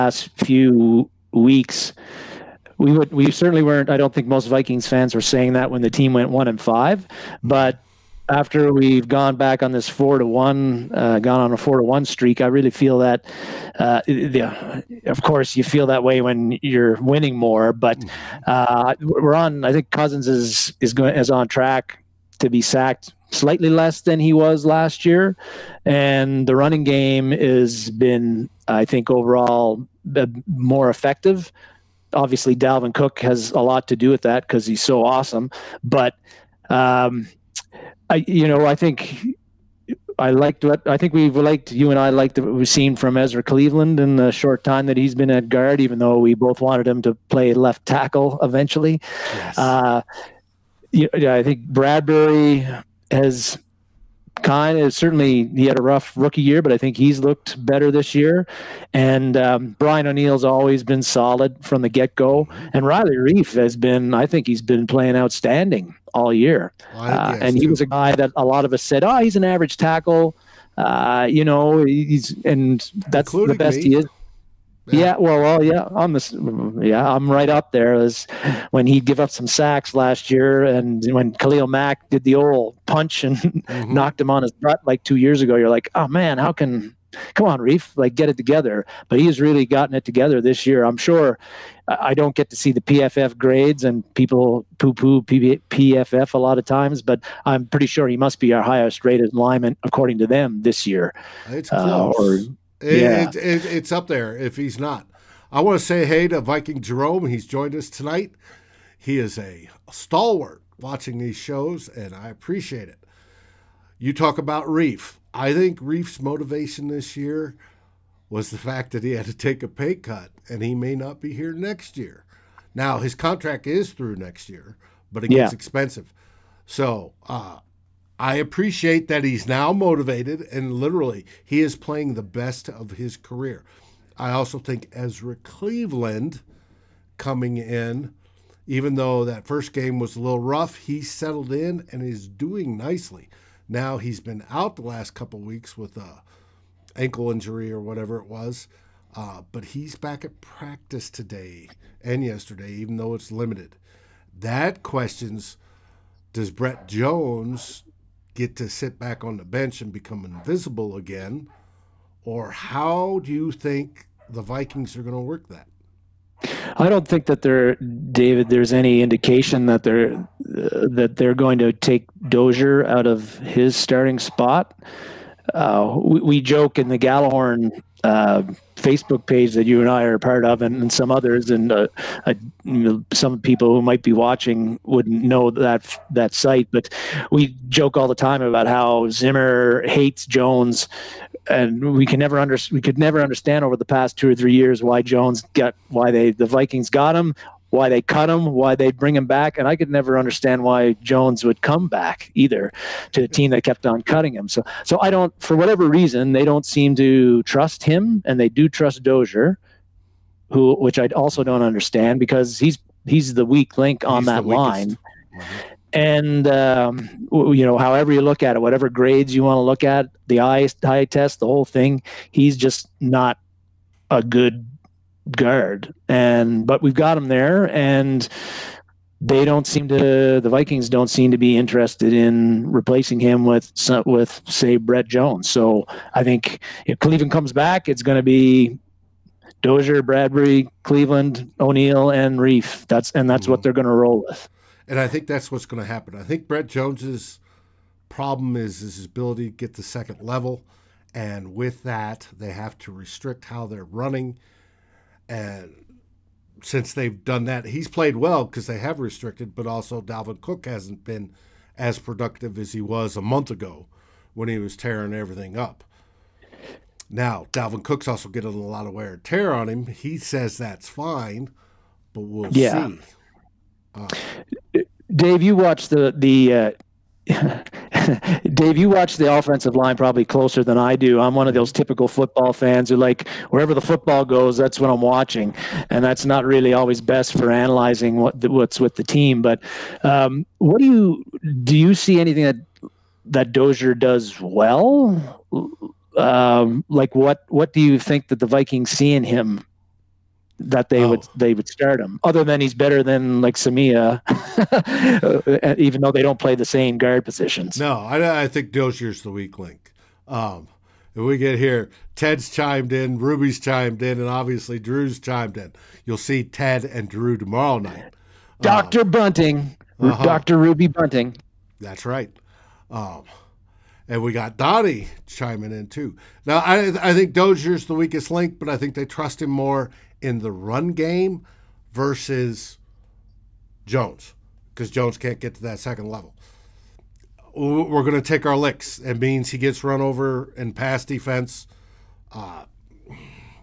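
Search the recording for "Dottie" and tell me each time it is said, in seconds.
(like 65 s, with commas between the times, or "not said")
324 s.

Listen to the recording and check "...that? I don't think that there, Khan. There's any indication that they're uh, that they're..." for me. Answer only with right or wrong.
wrong.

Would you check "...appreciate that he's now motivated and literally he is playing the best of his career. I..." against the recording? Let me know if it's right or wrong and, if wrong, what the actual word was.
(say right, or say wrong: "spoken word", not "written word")
right.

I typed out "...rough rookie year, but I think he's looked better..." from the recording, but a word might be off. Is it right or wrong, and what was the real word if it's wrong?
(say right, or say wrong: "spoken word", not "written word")
right.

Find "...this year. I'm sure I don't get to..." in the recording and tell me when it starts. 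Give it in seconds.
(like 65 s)
90 s.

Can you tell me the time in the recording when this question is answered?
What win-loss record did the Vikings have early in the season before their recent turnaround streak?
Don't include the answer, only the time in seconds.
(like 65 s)
6 s.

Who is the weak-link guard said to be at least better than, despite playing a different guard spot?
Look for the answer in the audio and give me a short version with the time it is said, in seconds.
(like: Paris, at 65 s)
Samia, at 303 s.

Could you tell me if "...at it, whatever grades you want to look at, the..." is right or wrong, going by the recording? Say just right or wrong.
right.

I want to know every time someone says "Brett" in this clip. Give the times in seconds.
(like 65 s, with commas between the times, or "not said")
156 s, 234 s, 246 s.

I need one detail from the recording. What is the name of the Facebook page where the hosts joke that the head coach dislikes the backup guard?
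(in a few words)
Gjallarhorn.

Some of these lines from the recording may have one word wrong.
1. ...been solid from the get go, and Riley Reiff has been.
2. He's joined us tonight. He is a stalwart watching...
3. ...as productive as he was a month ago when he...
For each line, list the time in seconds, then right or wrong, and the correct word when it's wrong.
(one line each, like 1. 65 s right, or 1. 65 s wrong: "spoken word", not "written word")
1. 60 s right
2. 107 s right
3. 261 s right.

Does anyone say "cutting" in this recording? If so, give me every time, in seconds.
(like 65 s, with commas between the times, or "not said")
204 s.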